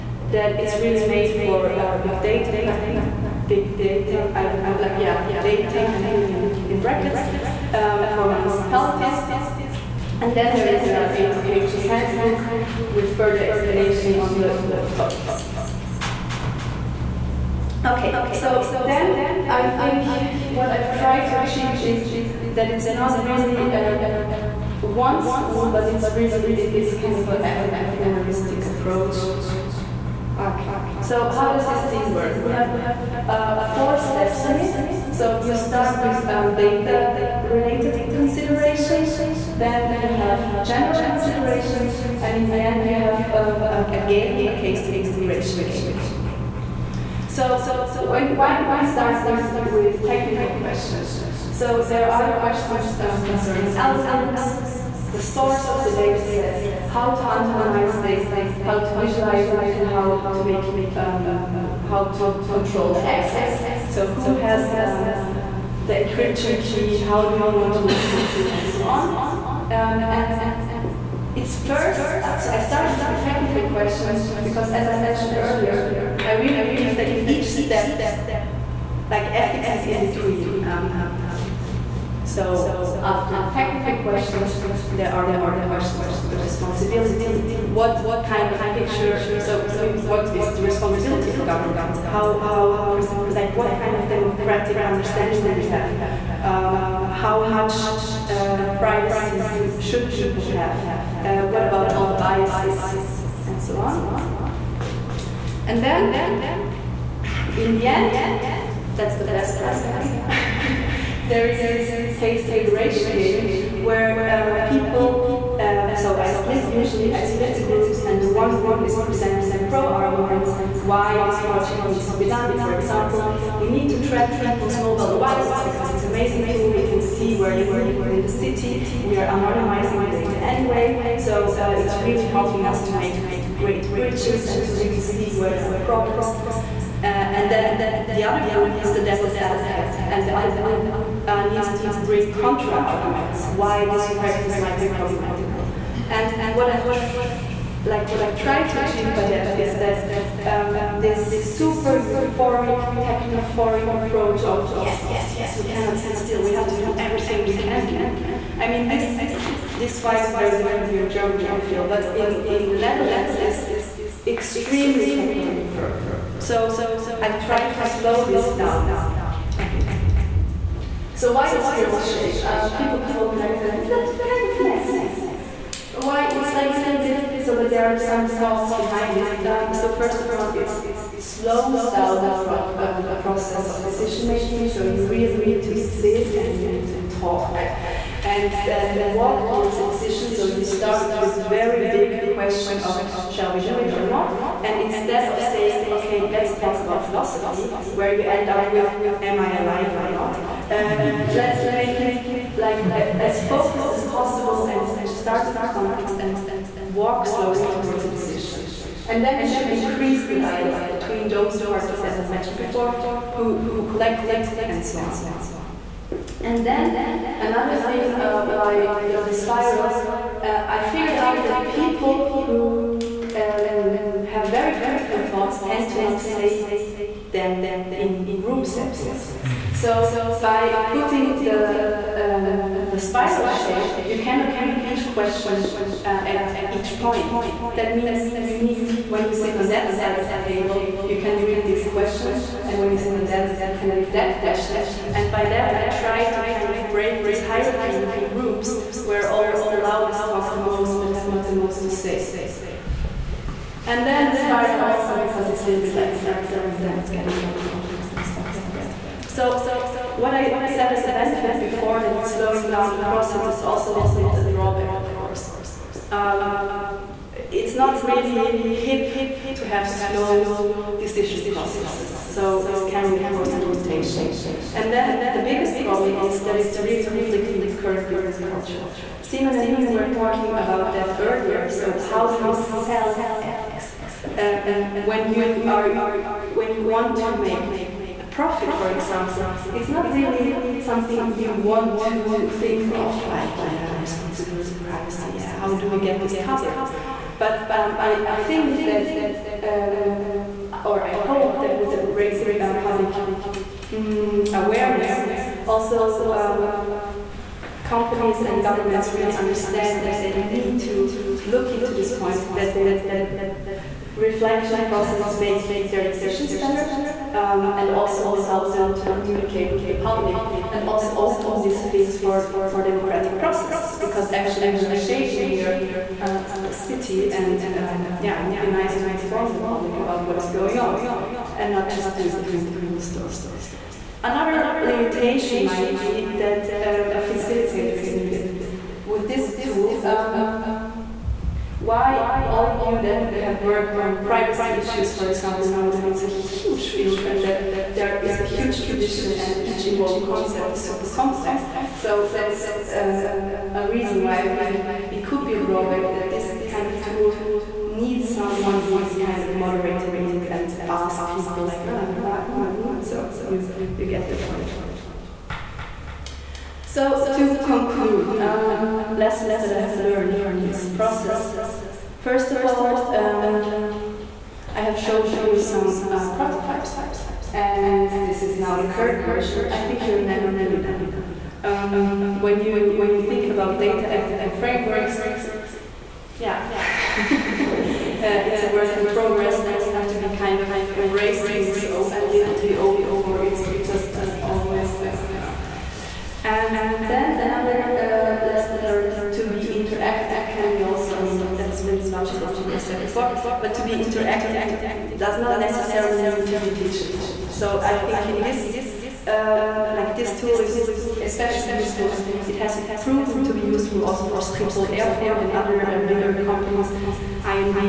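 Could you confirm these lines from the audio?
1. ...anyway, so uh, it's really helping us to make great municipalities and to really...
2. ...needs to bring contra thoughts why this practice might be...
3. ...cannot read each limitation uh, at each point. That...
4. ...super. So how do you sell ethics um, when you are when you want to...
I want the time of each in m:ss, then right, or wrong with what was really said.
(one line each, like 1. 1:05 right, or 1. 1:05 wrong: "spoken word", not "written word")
1. 2:10 wrong: "bridges", not "municipalities"
2. 2:21 wrong: "arguments", not "thoughts"
3. 3:54 wrong: "question", not "limitation"
4. 4:41 wrong: "earlier", not "super".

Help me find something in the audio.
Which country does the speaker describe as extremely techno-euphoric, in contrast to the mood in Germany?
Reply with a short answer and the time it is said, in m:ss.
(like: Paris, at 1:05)
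the Netherlands, at 2:42.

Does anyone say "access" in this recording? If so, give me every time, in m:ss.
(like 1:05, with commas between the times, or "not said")
1:03.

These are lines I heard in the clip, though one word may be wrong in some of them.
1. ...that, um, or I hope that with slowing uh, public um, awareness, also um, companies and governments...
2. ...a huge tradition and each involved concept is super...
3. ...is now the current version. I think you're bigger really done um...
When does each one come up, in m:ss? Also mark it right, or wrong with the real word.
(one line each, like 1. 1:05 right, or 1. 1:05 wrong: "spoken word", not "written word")
1. 4:58 wrong: "raising", not "slowing"
2. 5:48 right
3. 6:18 wrong: "never", not "bigger".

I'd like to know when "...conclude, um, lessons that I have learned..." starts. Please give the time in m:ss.
6:07.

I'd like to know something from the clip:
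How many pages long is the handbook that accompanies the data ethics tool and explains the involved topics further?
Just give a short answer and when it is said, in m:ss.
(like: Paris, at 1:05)
80, at 0:11.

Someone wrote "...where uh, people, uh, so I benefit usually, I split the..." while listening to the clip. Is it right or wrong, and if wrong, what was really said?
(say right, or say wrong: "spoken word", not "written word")
wrong: "split", not "benefit".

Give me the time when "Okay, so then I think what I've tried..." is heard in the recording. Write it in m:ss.
0:17.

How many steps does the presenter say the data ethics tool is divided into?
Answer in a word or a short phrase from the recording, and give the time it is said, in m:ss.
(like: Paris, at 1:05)
4, at 0:33.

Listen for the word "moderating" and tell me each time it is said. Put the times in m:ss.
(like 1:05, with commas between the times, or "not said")
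5:59.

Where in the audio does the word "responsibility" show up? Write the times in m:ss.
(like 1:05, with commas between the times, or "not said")
1:26, 1:30, 4:54.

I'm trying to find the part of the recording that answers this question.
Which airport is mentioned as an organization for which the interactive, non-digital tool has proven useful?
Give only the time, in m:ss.
6:54.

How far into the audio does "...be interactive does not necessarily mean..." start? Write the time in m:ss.
6:43.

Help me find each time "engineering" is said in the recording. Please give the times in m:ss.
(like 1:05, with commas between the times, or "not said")
not said.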